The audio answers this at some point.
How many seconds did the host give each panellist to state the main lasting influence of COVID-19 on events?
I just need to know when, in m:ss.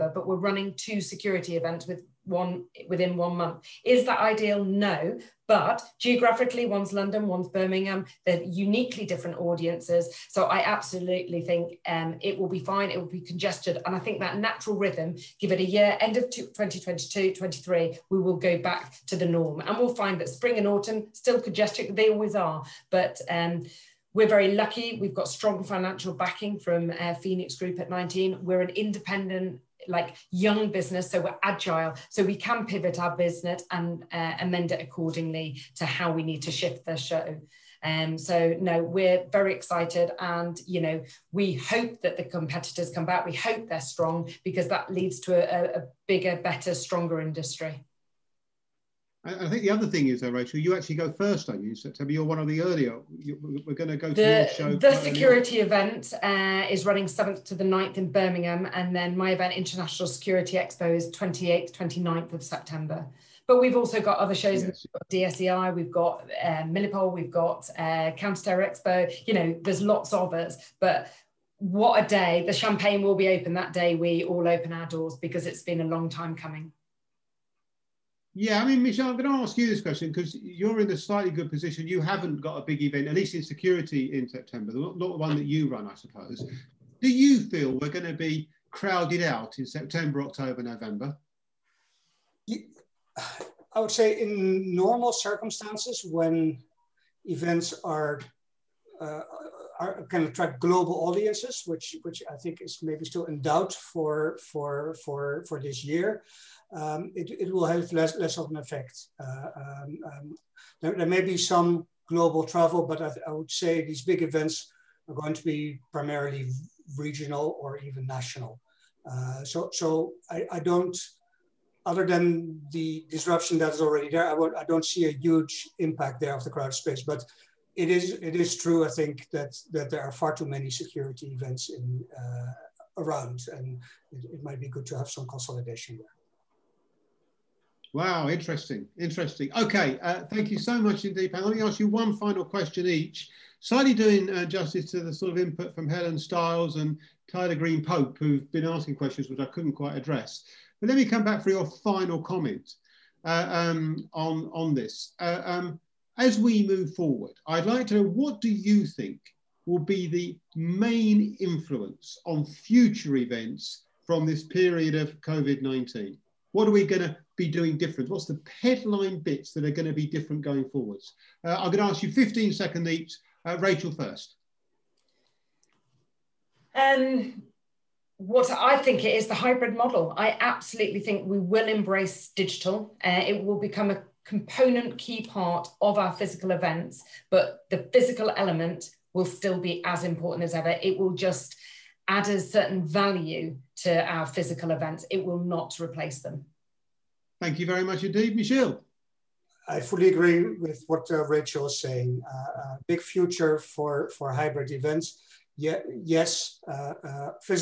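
2:52.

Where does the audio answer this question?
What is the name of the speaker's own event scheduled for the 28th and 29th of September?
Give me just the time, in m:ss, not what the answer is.
0:59.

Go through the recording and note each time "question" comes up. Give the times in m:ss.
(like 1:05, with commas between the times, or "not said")
1:19, 2:22, 2:28.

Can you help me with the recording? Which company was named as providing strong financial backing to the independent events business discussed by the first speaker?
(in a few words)
Phoenix Group.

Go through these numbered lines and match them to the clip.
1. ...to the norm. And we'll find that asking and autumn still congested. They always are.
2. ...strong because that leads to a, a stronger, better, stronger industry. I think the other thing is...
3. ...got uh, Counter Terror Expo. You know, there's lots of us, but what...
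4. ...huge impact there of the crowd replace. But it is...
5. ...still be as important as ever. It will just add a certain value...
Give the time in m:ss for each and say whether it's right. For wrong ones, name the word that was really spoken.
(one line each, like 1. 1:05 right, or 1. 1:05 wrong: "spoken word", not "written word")
1. 0:19 wrong: "spring", not "asking"
2. 0:43 wrong: "bigger", not "stronger"
3. 1:07 right
4. 2:05 wrong: "space", not "replace"
5. 3:09 right.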